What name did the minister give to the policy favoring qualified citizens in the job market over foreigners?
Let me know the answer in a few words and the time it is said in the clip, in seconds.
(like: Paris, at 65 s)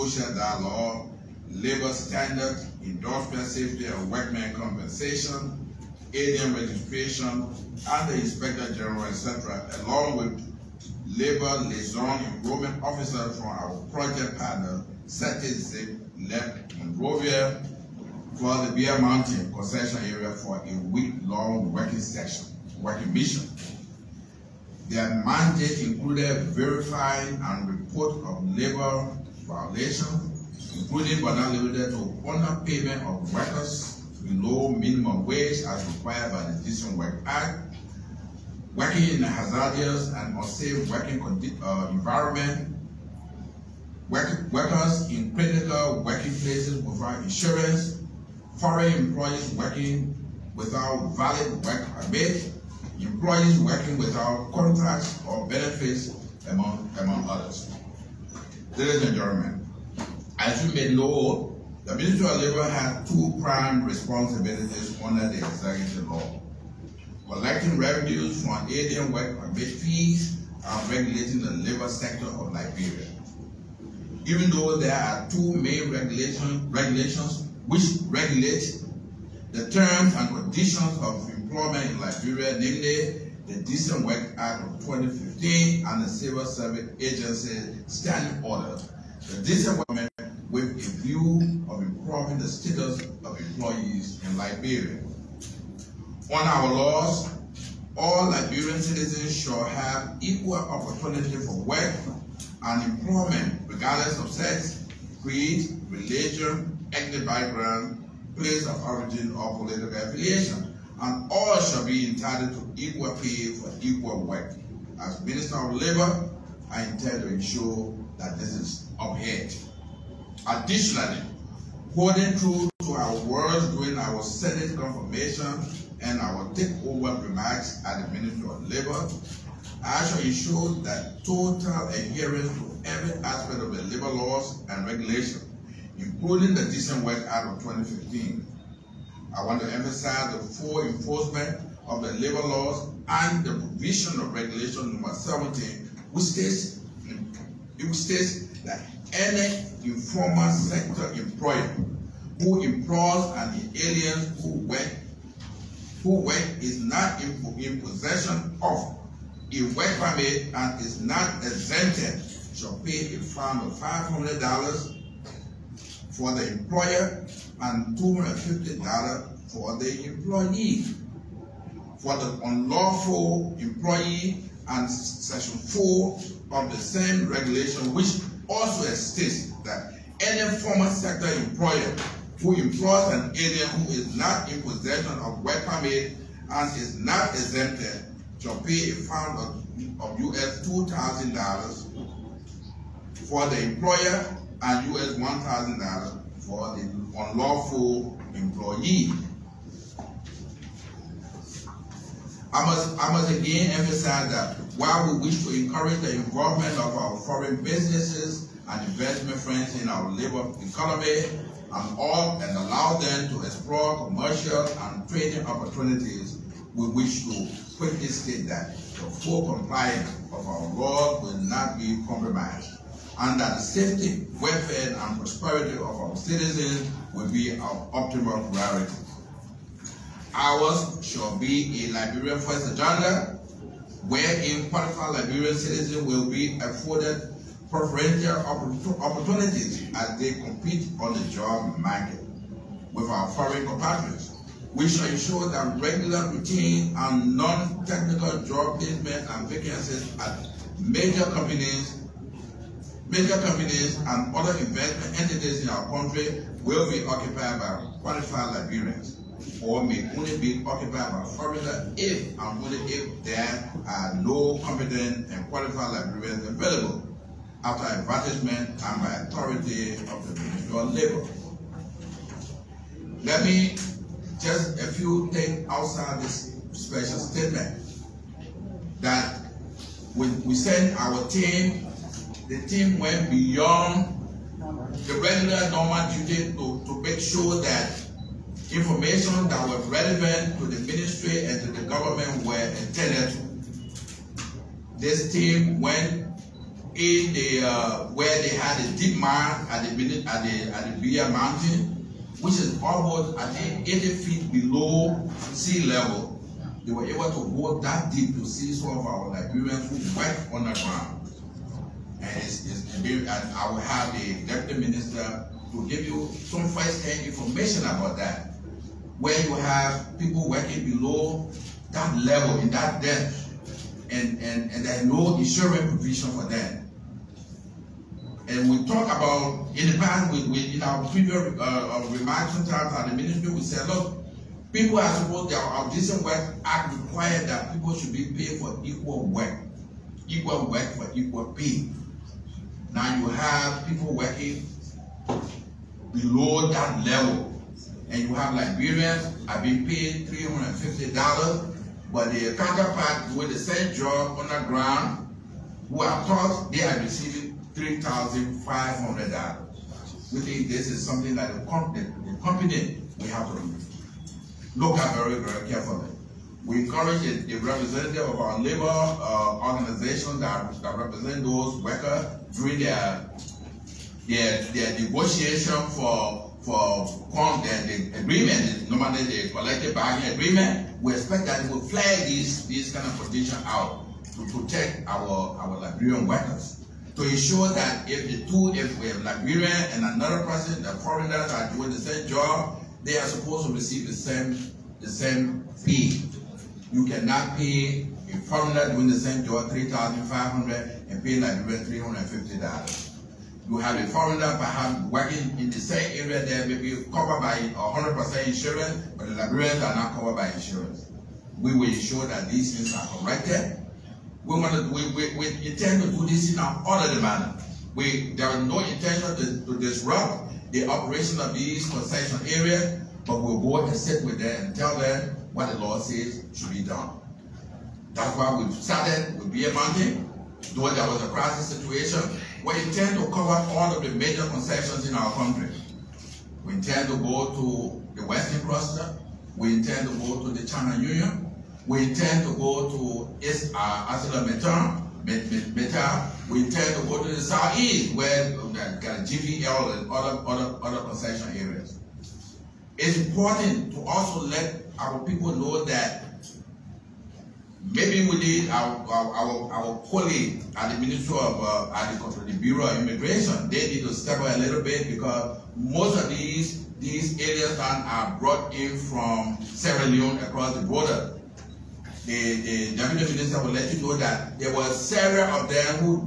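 Liberian First Agenda, at 231 s.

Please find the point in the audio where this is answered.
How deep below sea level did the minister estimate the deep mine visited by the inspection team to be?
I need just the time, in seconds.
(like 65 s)
303 s.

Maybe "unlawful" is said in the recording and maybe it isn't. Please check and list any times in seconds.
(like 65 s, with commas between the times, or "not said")
172 s, 197 s.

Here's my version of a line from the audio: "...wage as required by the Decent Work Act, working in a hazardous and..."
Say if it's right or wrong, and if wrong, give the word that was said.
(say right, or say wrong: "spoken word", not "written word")
right.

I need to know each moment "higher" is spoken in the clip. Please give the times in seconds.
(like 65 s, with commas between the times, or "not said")
not said.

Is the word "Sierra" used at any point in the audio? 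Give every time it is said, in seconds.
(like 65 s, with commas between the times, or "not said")
469 s.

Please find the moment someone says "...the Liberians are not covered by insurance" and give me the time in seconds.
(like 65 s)
409 s.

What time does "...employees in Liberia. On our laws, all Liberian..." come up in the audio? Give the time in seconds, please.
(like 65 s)
93 s.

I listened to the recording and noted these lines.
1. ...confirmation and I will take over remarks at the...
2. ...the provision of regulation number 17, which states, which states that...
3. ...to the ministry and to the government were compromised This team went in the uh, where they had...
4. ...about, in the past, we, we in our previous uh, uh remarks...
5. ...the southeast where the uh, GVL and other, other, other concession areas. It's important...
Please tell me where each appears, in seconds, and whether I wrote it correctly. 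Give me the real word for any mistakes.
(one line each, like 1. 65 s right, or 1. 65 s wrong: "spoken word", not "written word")
1. 124 s right
2. 143 s right
3. 290 s wrong: "attended", not "compromised"
4. 329 s right
5. 447 s right.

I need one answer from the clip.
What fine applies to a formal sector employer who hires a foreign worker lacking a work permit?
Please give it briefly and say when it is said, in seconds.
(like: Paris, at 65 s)
US $2,000, at 190 s.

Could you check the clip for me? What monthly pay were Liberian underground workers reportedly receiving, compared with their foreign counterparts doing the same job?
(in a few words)
$350.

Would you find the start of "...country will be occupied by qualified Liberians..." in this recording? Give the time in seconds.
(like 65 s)
255 s.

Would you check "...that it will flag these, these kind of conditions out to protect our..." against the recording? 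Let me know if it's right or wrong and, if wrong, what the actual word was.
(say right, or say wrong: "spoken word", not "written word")
right.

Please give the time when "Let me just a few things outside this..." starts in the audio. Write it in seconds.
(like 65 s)
273 s.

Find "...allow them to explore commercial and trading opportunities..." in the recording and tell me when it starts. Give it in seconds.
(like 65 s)
212 s.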